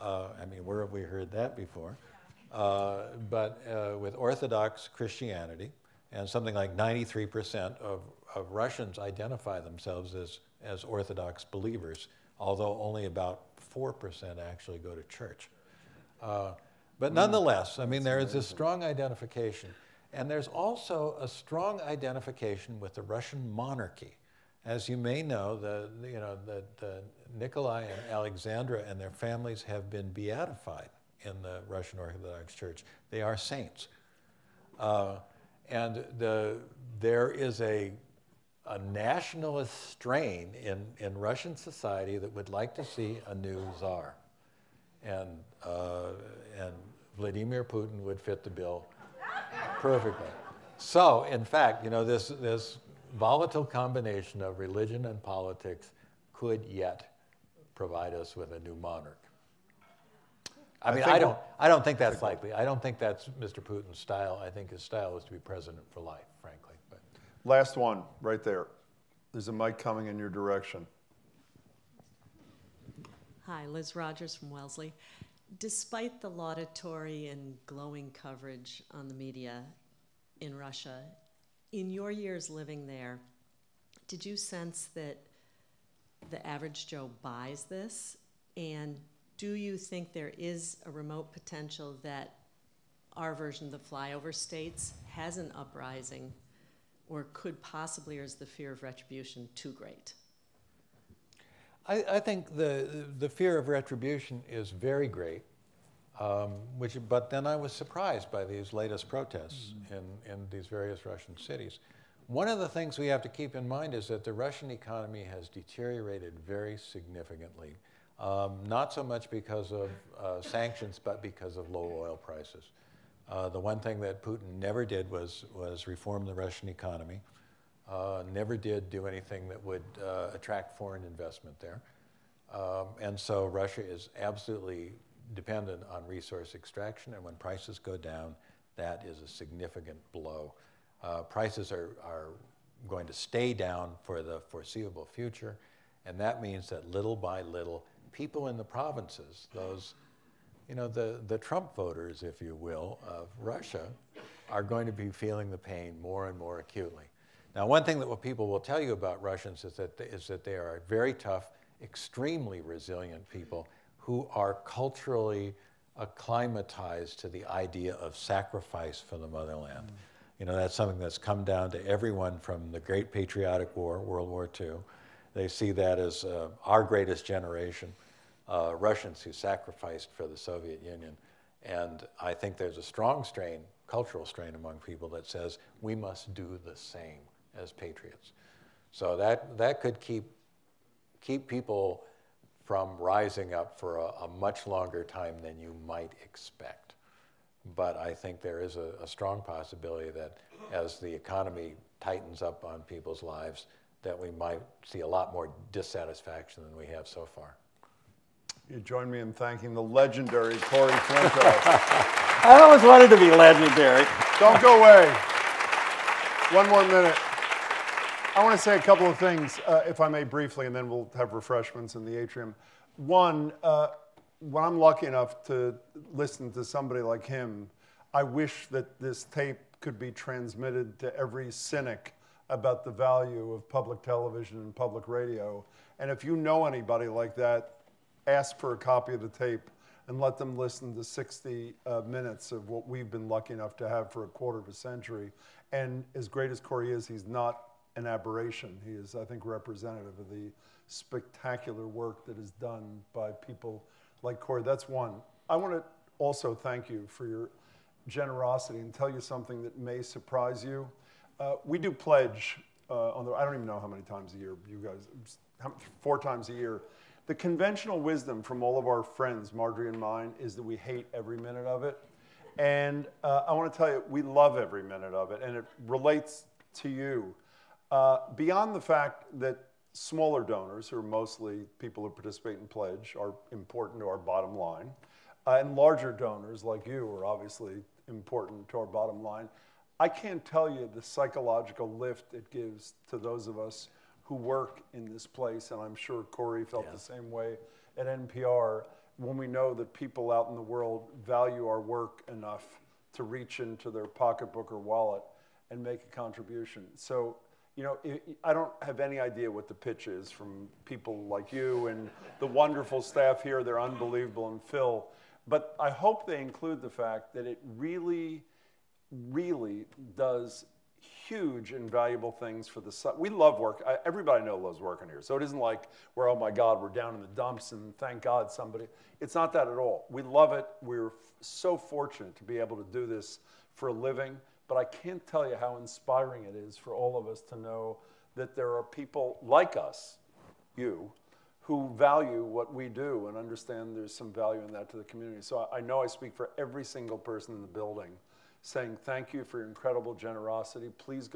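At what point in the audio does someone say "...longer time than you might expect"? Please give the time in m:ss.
3:14.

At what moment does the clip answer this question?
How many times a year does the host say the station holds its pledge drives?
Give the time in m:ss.
4:26.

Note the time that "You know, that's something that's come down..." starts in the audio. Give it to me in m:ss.
2:50.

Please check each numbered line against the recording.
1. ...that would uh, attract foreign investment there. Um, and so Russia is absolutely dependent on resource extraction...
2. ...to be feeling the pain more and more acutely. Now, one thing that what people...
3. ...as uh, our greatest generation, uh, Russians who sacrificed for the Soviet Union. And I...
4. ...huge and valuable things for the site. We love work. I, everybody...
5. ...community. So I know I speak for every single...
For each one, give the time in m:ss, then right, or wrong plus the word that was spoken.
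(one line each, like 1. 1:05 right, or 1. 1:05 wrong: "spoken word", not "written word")
1. 2:09 right
2. 2:34 right
3. 2:55 right
4. 5:21 right
5. 5:45 right.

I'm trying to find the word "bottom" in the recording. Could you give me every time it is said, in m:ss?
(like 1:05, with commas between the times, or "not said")
4:44, 4:48.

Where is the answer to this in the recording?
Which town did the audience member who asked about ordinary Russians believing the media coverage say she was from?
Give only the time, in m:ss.
1:14.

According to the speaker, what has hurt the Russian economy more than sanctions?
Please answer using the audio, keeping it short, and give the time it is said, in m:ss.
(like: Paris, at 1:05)
Low oil prices, at 2:01.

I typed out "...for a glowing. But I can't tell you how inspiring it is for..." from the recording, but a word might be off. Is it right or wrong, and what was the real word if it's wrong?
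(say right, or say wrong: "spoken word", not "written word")
wrong: "living", not "glowing".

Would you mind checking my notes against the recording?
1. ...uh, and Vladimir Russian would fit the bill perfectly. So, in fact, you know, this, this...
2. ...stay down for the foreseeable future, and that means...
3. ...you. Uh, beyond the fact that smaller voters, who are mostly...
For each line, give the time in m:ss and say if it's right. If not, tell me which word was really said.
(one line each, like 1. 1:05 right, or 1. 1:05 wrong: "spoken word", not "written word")
1. 0:45 wrong: "Putin", not "Russian"
2. 2:23 right
3. 4:36 wrong: "donors", not "voters".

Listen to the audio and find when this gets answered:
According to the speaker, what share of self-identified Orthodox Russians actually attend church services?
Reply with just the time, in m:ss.
0:13.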